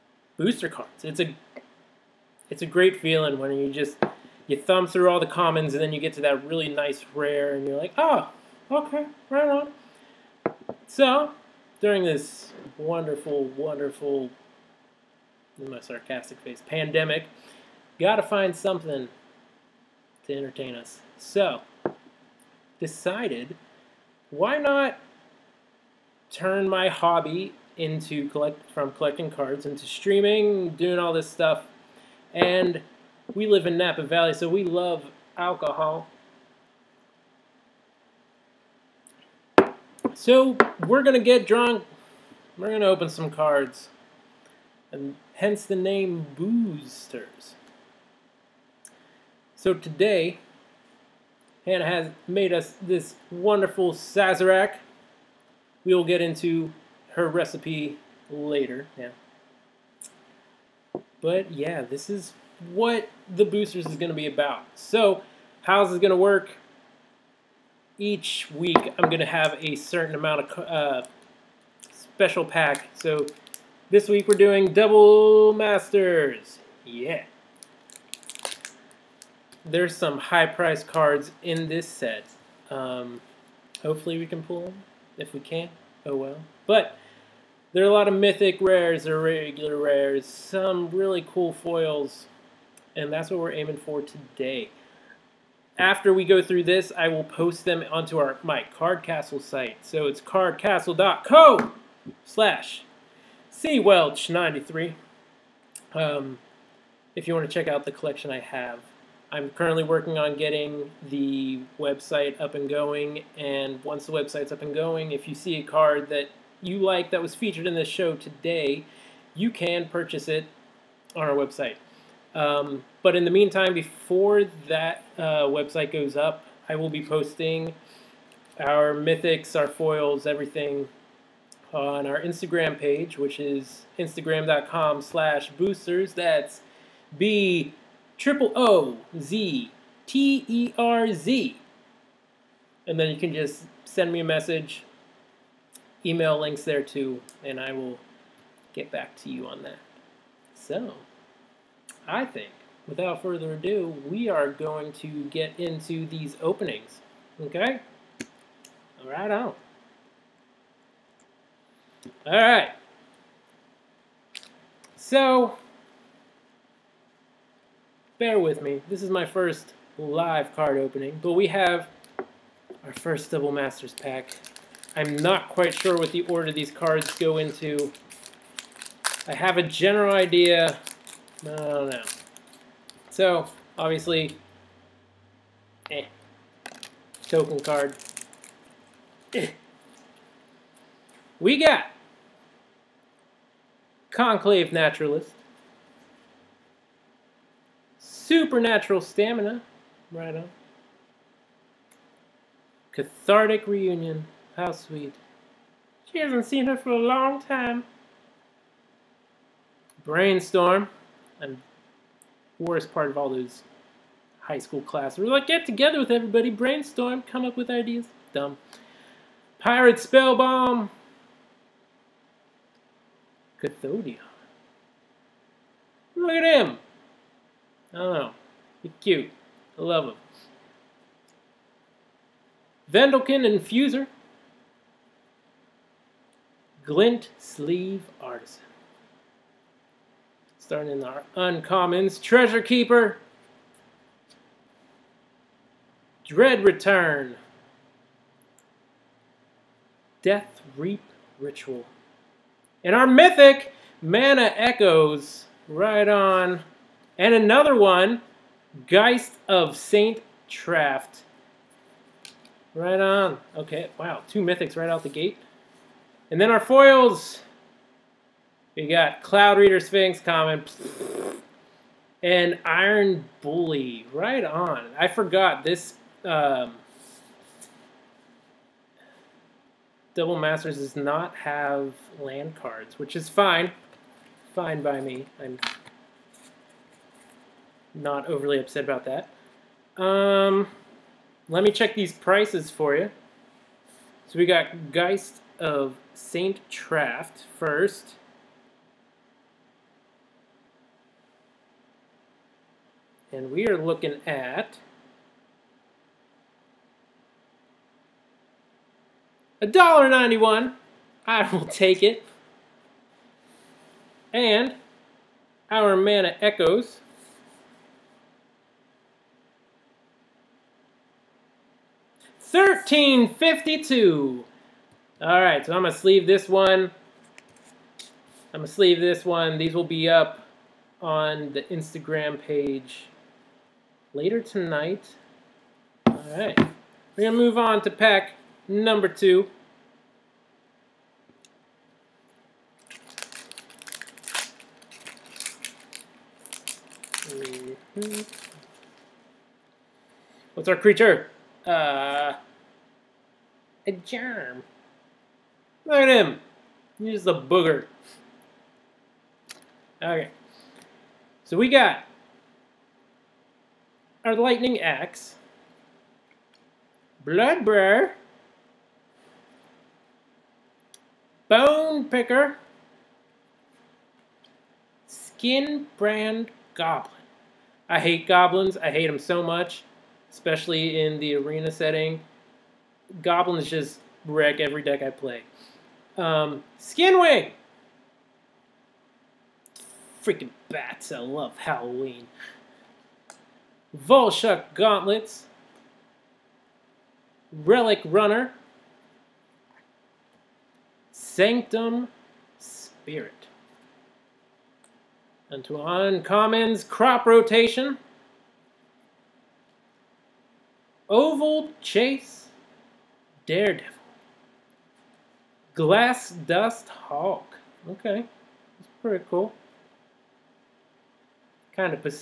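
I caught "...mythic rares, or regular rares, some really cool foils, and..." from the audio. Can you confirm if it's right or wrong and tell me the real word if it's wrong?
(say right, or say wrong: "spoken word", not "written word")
right.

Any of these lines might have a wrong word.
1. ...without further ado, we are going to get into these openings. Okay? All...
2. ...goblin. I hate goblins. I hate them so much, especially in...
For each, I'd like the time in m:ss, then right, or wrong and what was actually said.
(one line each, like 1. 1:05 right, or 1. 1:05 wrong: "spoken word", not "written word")
1. 2:32 right
2. 6:16 right.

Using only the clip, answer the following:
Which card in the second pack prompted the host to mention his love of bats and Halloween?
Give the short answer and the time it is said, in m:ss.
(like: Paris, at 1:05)
Skinwing, at 6:26.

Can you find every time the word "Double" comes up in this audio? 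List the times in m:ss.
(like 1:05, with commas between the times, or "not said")
1:14, 2:53, 4:40.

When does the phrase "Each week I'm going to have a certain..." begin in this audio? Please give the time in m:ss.
1:07.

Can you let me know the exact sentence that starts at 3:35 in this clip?
We're like, get together with everybody, brainstorm, come up with ideas.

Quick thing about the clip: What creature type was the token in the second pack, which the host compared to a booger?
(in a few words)
germ.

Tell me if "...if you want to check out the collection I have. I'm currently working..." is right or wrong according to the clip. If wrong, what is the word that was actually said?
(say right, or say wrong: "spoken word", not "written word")
right.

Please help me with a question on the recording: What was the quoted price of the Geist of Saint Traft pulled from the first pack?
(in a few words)
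$1.91.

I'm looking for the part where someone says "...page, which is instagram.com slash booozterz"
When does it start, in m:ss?
2:12.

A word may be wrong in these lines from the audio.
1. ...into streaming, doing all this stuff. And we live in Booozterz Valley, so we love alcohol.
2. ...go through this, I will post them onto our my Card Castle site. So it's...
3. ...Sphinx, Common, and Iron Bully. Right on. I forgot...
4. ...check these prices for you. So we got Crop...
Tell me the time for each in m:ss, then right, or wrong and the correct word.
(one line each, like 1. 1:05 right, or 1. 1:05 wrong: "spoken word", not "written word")
1. 0:29 wrong: "Napa", not "Booozterz"
2. 1:36 right
3. 4:29 right
4. 4:51 wrong: "Geist", not "Crop".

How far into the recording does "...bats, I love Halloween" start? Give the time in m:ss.
6:30.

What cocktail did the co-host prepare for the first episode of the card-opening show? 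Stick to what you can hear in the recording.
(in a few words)
Sazerac.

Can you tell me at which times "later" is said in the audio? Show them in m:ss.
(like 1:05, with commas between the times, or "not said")
0:58, 5:34.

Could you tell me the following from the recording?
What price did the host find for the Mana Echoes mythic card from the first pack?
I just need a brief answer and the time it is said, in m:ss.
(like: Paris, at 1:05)
13.52, at 5:22.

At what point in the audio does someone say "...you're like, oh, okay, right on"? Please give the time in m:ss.
0:07.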